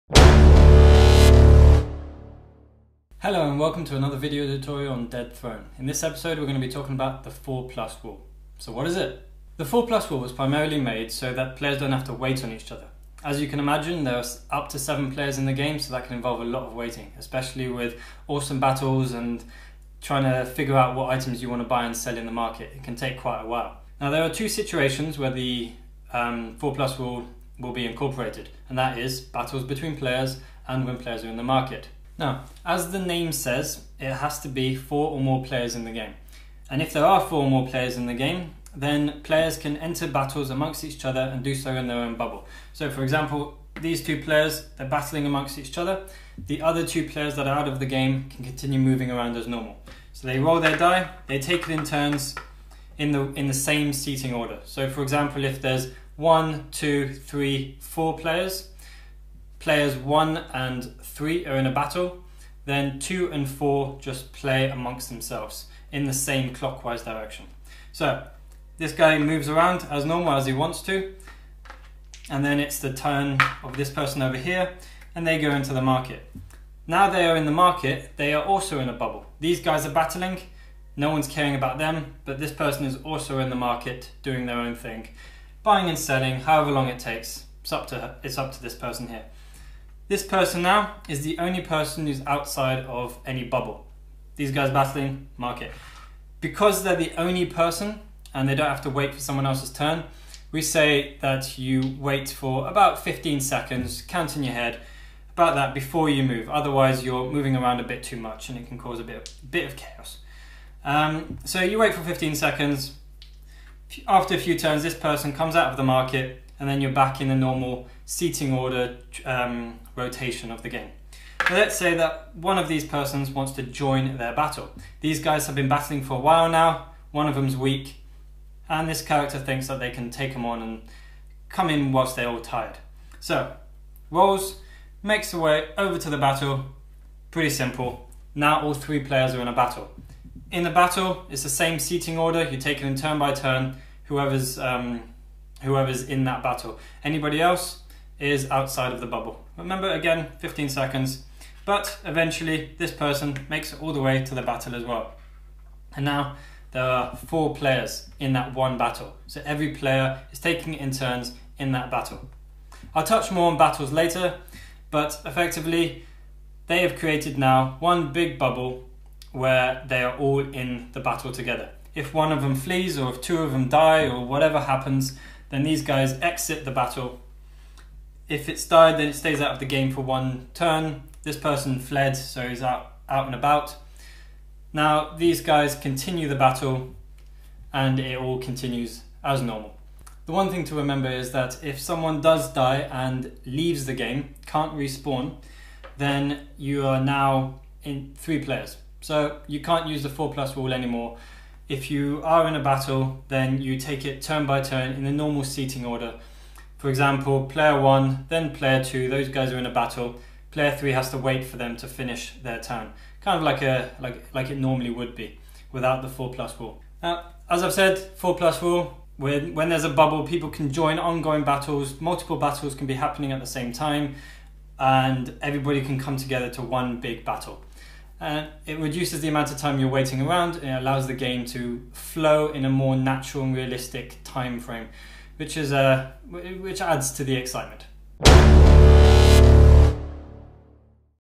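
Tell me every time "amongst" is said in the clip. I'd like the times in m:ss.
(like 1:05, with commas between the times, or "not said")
0:40, 0:45, 1:04.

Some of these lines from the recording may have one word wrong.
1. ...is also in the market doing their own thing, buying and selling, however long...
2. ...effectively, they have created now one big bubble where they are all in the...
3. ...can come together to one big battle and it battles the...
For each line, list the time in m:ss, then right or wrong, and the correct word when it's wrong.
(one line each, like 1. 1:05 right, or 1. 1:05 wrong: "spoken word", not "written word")
1. 1:22 right
2. 2:45 right
3. 3:45 wrong: "reduces", not "battles".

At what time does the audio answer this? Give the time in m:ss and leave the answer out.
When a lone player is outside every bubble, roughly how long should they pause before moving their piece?
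1:42.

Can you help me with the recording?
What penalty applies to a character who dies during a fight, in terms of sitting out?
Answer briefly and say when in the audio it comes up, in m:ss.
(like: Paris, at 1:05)
One turn, at 2:59.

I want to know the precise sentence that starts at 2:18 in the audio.
Now all three players are in a battle.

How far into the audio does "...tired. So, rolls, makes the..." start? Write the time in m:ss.
2:12.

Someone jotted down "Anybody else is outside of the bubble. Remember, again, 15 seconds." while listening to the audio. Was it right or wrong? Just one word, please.
right.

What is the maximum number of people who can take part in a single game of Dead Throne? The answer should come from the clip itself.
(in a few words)
7.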